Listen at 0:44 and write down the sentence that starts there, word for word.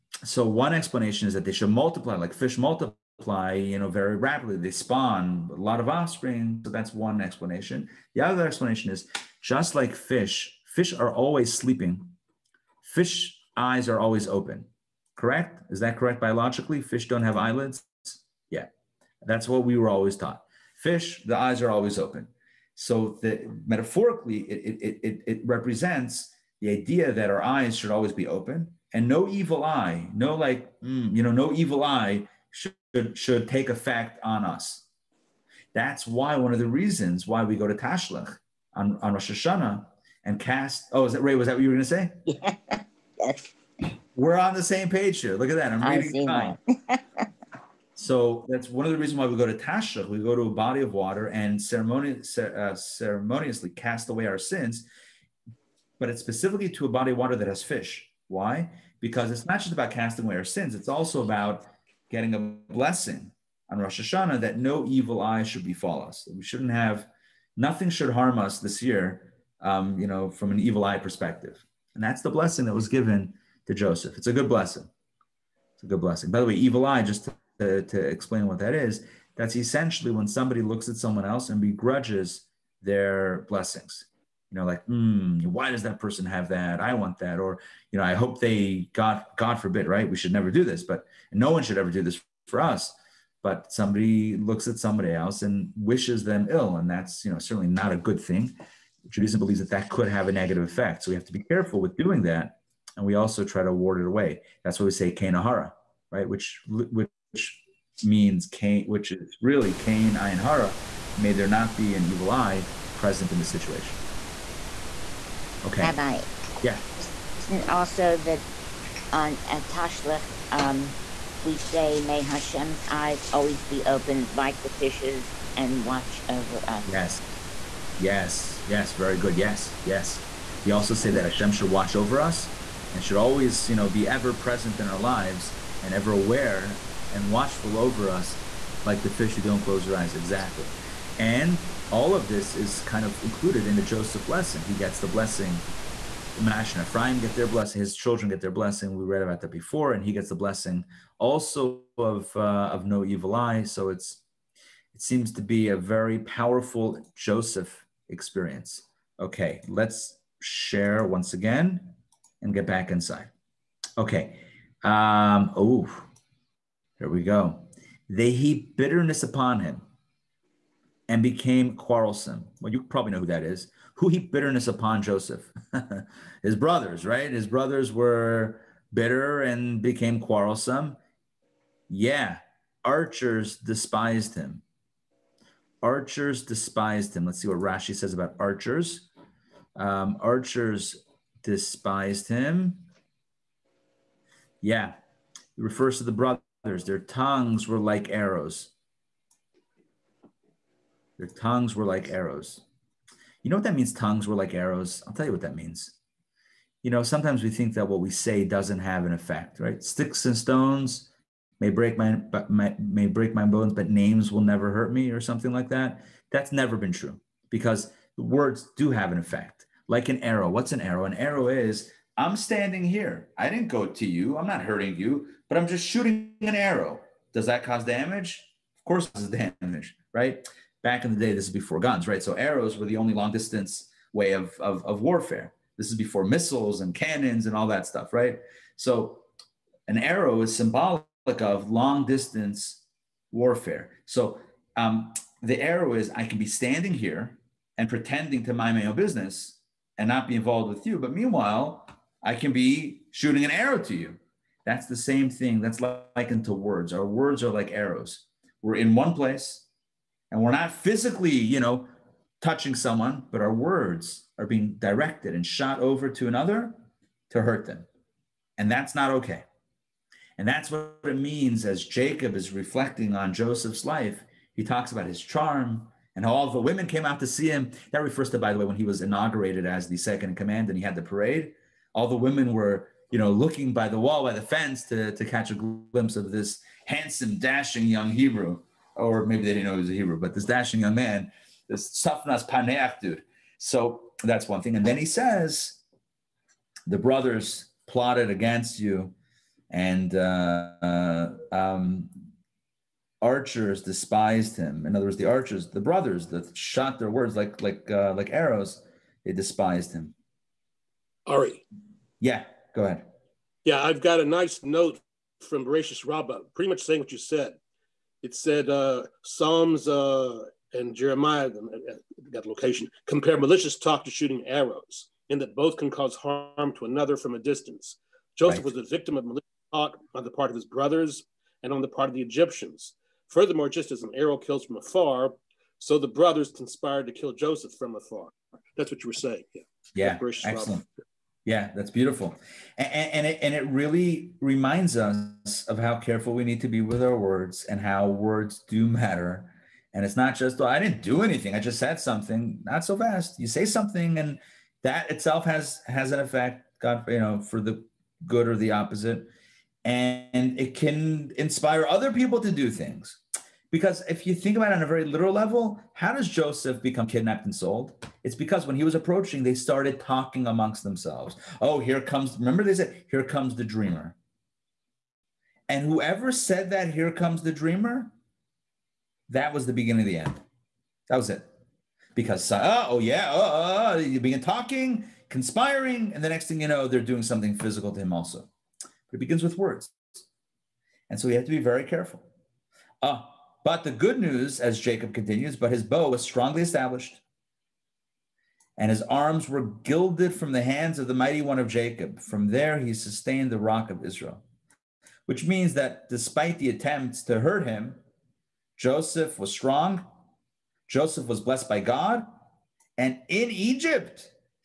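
We're on the same page here.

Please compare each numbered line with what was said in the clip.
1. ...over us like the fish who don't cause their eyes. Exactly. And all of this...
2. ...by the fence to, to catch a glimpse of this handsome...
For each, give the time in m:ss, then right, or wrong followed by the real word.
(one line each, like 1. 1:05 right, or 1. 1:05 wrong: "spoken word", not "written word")
1. 2:17 wrong: "close", not "cause"
2. 4:44 right.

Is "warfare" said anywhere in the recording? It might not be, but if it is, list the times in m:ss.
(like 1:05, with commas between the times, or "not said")
3:55, 4:03.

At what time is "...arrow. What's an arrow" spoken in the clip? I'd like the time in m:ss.
3:40.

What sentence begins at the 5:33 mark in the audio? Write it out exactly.
Furthermore, just as an arrow kills from afar, so the brothers conspired to kill Joseph from afar.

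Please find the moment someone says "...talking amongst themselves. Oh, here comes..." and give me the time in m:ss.
6:09.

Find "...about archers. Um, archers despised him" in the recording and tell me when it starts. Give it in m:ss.
3:08.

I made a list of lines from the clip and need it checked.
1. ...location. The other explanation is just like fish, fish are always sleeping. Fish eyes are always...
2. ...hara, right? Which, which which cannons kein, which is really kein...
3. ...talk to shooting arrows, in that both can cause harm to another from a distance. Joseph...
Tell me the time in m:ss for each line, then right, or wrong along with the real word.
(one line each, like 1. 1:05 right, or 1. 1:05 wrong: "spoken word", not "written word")
1. 0:07 wrong: "explanation", not "location"
2. 1:45 wrong: "means", not "cannons"
3. 5:23 right.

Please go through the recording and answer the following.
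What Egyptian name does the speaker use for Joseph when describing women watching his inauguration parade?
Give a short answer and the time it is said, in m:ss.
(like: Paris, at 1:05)
Tzafnas Paneach, at 4:51.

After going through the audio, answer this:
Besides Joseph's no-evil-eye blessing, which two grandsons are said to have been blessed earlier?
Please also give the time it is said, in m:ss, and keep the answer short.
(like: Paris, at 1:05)
Manasseh and Ephraim, at 2:26.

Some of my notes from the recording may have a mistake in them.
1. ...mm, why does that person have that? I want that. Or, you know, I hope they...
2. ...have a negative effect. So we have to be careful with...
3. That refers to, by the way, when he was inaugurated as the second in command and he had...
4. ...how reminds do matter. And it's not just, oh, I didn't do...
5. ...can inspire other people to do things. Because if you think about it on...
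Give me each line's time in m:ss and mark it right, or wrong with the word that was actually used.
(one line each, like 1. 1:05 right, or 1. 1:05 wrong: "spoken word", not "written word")
1. 1:24 right
2. 1:40 right
3. 4:37 right
4. 5:47 wrong: "words", not "reminds"
5. 6:00 right.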